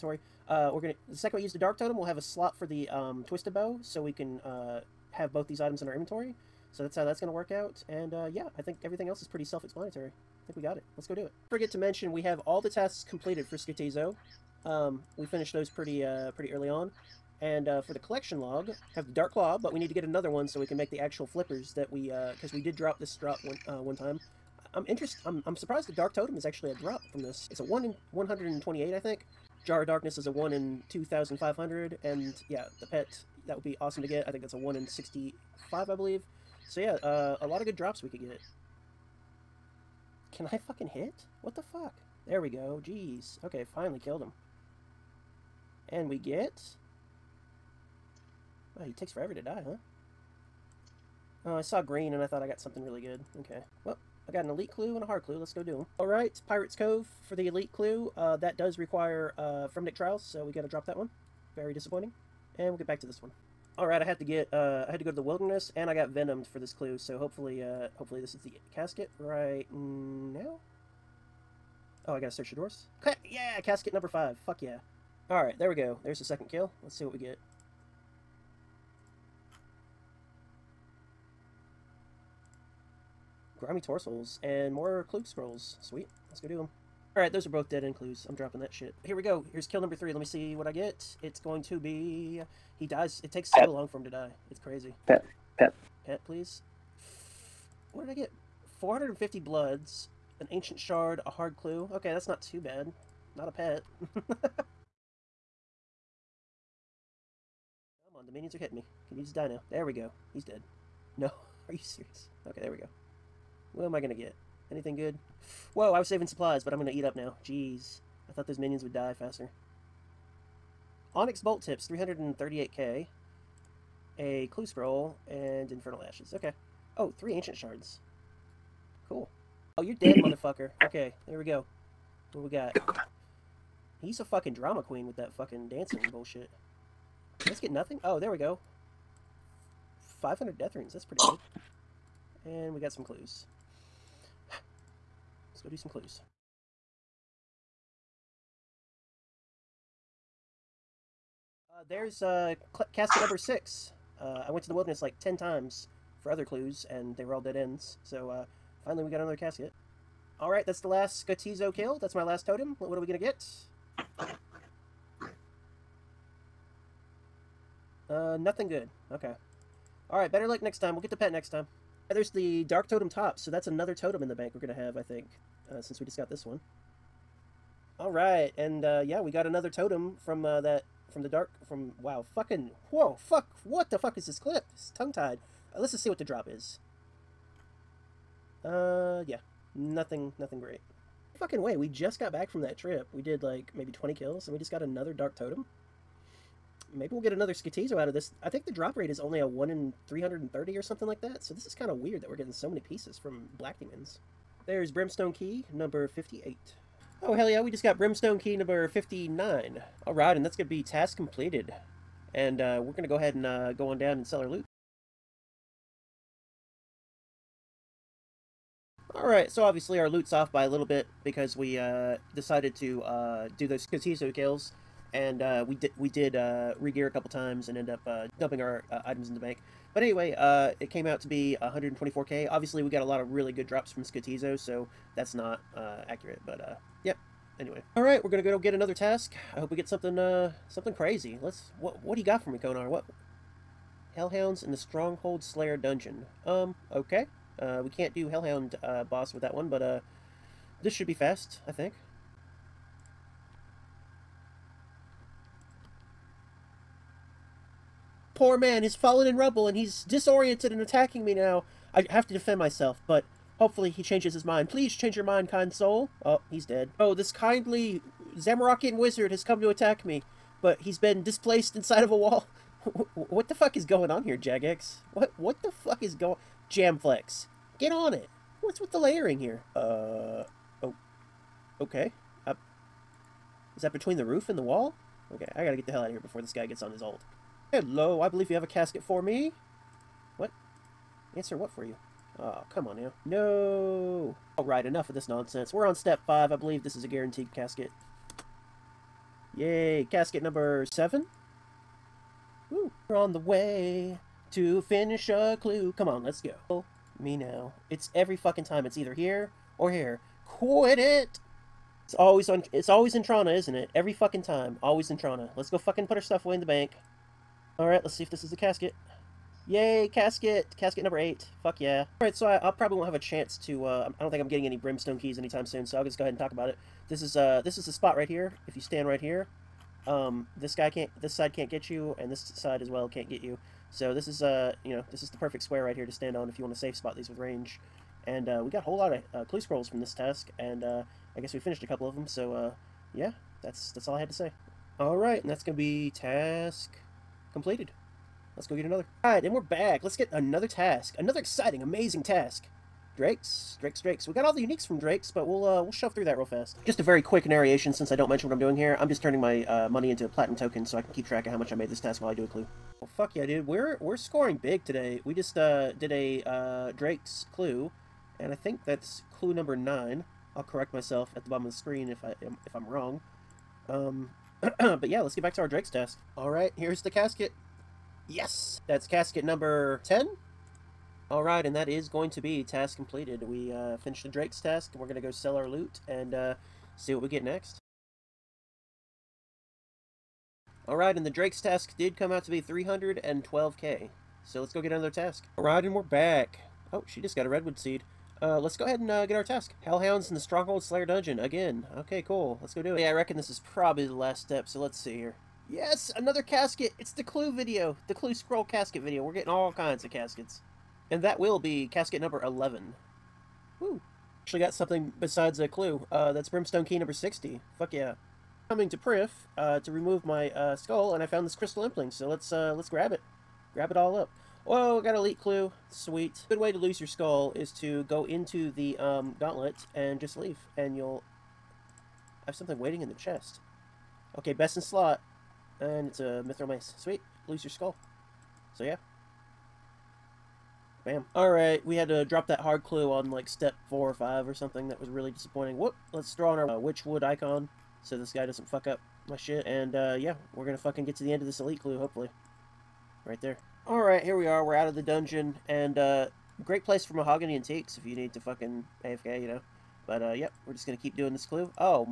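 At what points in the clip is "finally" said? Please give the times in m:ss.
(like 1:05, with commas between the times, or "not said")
0:43, 2:38.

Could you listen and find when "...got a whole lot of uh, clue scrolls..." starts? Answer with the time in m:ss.
5:38.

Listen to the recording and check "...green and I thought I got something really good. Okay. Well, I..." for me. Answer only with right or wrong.
right.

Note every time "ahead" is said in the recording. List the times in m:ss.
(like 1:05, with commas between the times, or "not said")
3:33, 5:26, 6:38.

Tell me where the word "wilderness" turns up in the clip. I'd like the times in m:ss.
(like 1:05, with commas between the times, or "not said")
1:05, 2:34.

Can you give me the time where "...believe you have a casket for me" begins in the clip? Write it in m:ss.
4:48.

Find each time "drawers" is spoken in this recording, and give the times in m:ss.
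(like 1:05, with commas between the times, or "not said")
1:12.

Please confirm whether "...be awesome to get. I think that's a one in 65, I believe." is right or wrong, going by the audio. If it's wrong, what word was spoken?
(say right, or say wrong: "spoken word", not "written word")
right.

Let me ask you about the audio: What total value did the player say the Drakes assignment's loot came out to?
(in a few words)
312k.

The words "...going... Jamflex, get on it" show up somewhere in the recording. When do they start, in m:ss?
4:36.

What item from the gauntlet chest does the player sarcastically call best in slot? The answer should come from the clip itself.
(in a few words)
mithril mace.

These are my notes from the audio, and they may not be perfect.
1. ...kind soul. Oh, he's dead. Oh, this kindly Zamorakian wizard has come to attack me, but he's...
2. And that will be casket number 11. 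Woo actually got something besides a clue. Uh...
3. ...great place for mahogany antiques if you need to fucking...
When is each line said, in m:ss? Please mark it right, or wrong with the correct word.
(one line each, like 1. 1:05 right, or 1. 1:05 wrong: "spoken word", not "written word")
1. 4:25 right
2. 6:51 right
3. 7:36 right.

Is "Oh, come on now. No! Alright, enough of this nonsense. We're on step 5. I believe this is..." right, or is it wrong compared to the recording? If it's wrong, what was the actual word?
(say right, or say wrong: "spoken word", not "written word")
right.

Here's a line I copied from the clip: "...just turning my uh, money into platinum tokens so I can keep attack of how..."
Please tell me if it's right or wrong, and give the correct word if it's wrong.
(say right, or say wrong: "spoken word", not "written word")
wrong: "track", not "attack".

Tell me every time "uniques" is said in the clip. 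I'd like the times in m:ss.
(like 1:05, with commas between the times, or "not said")
5:54.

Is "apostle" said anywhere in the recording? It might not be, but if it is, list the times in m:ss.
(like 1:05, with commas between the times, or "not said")
not said.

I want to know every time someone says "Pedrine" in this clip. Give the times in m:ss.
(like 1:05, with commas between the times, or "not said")
not said.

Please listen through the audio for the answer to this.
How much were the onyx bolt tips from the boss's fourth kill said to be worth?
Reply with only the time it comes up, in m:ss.
2:01.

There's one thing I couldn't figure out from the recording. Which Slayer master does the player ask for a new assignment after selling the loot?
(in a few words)
Konar.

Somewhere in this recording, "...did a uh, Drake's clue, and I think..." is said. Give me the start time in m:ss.
6:05.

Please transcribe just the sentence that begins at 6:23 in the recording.
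We uh, finished the Drake's task, and we're going to go sell our loot and uh, see what we get next.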